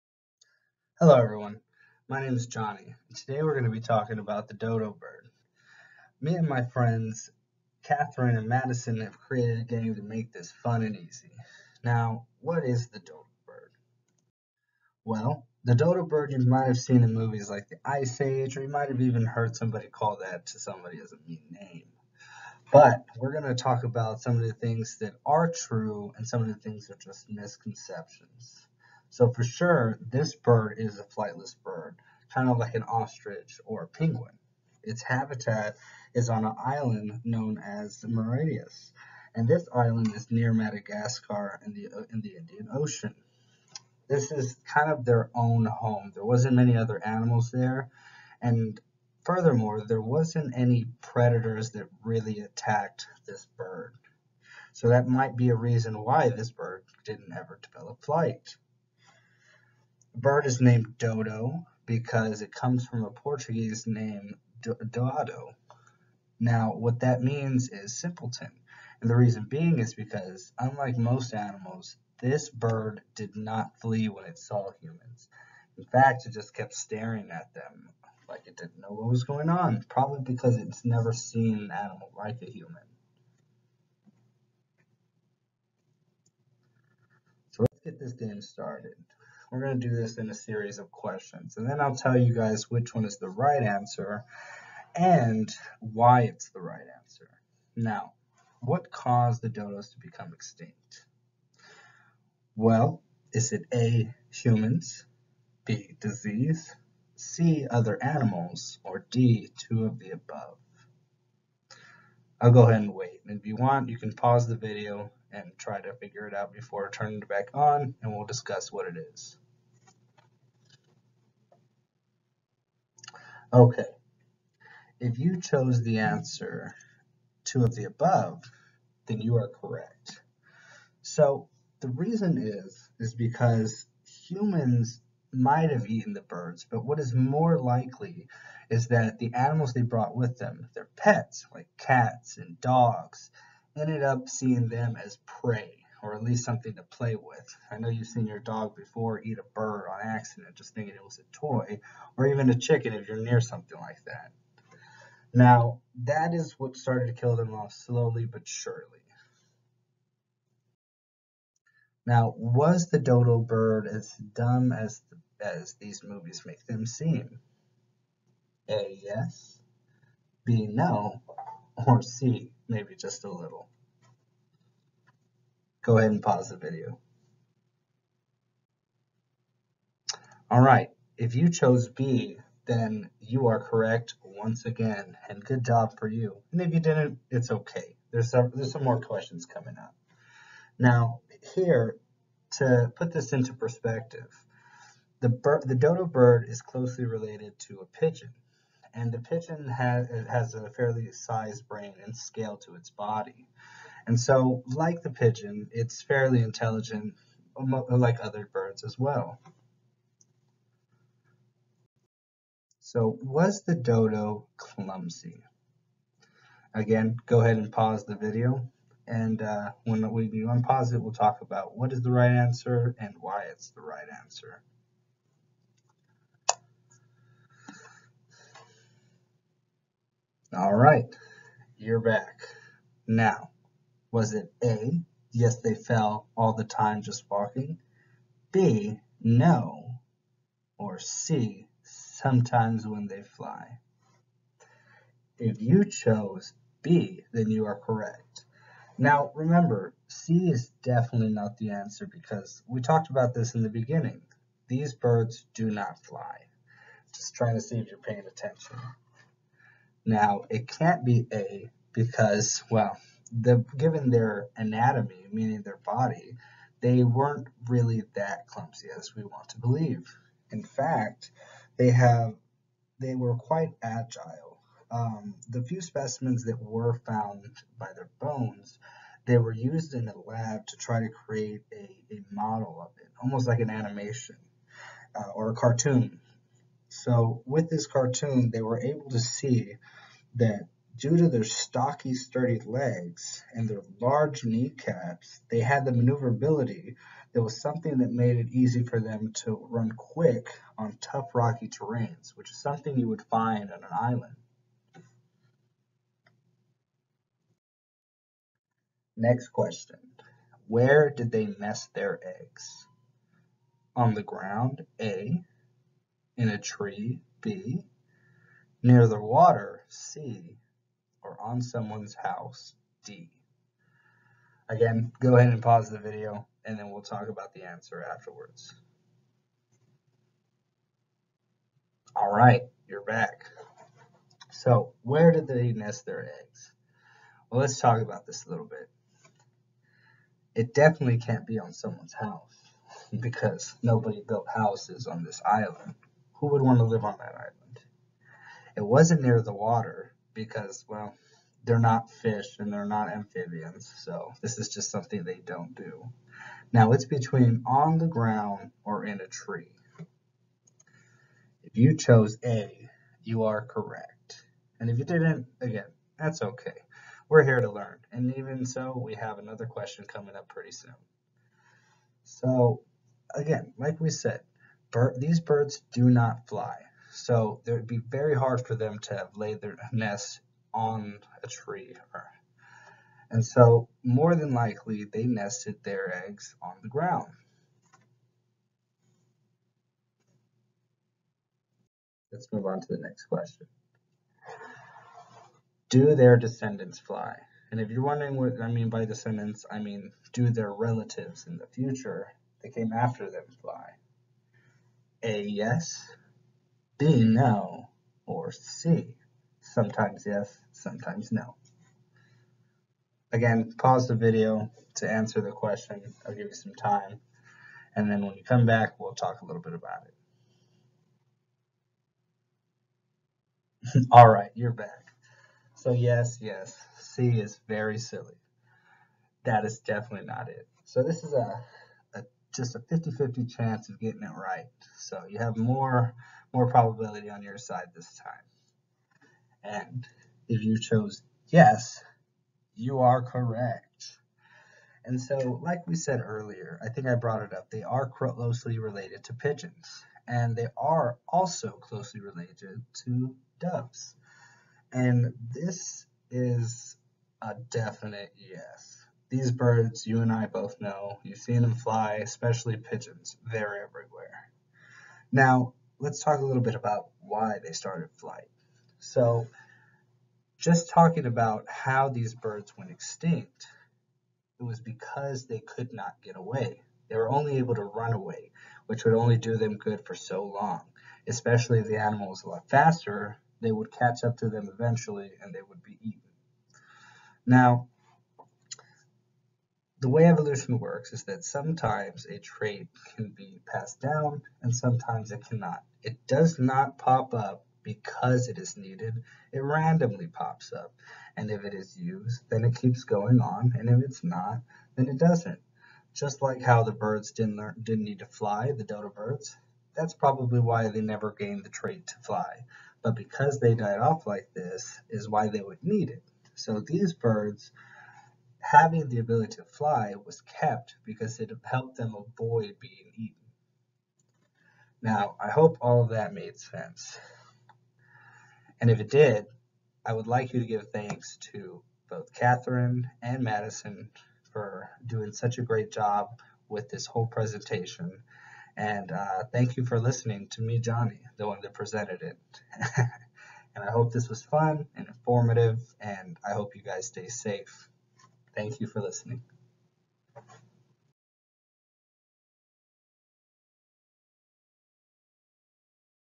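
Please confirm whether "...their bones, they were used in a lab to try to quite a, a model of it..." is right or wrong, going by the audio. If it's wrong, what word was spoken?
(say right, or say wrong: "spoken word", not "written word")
wrong: "create", not "quite".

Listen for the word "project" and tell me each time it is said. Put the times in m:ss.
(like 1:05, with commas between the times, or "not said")
not said.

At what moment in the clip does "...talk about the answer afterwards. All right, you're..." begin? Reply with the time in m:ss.
5:27.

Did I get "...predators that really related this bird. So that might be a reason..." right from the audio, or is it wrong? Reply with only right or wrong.
wrong.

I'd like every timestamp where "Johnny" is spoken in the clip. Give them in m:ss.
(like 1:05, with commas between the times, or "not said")
0:02, 9:00.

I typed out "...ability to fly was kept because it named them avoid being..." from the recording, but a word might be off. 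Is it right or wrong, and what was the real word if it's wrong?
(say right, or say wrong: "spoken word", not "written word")
wrong: "helped", not "named".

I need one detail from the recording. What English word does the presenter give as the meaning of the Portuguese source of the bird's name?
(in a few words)
simpleton.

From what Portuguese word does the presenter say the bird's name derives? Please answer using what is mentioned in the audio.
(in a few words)
Doado.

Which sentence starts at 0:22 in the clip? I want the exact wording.
But we're going to talk about some of the things that are true and some of the things that are just misconceptions.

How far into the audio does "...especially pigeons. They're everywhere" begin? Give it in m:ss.
7:42.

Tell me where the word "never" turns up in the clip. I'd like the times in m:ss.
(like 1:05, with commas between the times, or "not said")
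1:20, 8:31.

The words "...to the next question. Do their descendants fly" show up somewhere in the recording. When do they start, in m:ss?
6:32.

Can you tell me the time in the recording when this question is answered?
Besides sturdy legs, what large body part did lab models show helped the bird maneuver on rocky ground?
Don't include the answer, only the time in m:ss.
4:53.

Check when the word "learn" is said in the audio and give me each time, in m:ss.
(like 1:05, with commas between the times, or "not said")
6:07, 8:27.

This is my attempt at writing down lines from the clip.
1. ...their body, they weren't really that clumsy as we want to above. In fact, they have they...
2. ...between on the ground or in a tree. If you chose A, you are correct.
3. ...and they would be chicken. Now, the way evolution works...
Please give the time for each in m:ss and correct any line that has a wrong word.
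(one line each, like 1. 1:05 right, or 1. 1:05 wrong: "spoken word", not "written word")
1. 4:25 wrong: "believe", not "above"
2. 5:57 right
3. 8:05 wrong: "eaten", not "chicken".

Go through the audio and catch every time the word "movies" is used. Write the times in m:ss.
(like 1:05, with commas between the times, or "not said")
0:17, 2:46.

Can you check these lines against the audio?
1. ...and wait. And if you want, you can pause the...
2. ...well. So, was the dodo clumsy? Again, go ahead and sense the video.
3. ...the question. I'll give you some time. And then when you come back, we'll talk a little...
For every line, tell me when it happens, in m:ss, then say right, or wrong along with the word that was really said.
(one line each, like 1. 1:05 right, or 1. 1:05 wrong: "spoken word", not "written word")
1. 1:52 right
2. 3:28 wrong: "pause", not "sense"
3. 6:55 right.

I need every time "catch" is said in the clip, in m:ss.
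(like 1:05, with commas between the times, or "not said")
8:03.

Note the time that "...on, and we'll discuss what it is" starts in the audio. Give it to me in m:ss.
1:57.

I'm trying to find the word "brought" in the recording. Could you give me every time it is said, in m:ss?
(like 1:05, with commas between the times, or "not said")
2:19, 7:27.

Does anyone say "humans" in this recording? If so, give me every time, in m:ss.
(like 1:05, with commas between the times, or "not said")
1:14, 1:22, 1:44, 2:14.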